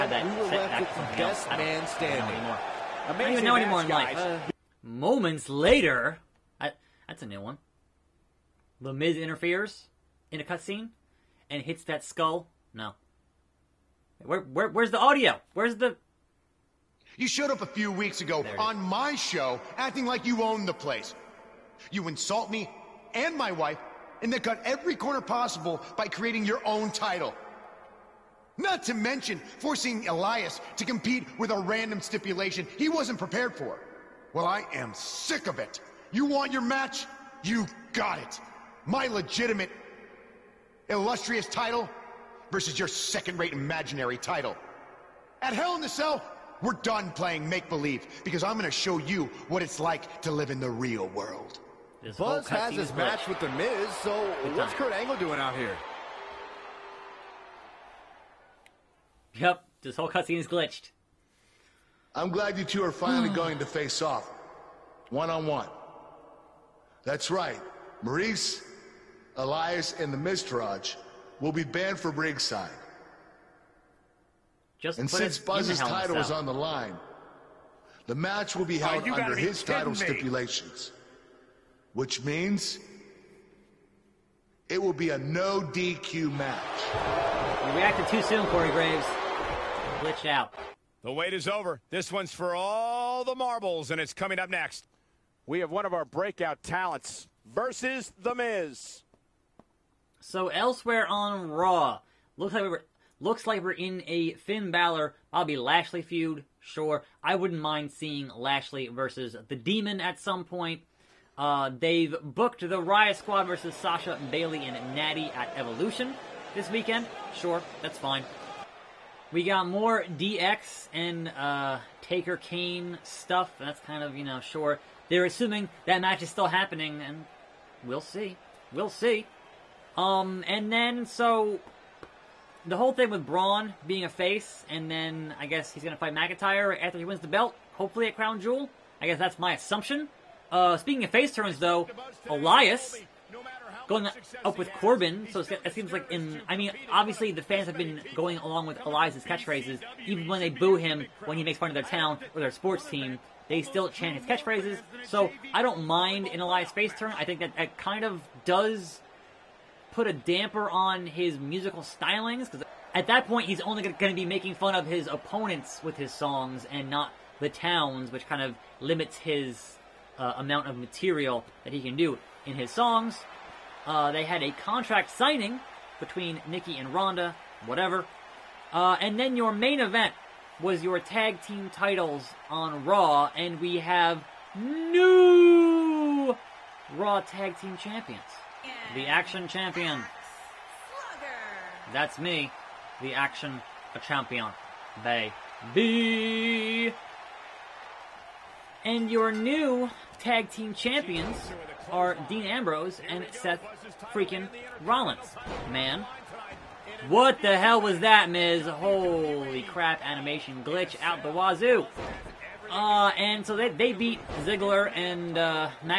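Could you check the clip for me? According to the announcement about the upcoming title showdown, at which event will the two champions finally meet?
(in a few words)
Hell in a Cell.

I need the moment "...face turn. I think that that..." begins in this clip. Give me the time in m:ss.
2:36.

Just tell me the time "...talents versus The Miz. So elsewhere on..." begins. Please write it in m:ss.
1:36.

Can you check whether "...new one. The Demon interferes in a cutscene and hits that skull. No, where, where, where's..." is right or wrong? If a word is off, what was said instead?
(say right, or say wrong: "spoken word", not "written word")
wrong: "Miz", not "Demon".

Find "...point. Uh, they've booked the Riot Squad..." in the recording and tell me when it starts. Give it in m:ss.
1:50.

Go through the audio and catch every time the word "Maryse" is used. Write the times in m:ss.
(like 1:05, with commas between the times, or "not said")
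1:08.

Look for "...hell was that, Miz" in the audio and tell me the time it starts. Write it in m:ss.
3:27.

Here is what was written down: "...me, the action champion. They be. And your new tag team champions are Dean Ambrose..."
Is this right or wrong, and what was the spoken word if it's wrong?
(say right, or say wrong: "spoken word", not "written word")
right.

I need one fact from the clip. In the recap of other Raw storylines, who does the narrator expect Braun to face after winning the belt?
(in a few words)
McIntyre.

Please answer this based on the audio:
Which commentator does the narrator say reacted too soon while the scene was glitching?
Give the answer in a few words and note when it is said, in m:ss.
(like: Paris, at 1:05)
Corey Graves, at 1:28.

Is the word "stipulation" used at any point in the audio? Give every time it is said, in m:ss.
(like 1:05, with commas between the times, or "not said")
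0:32, 1:19.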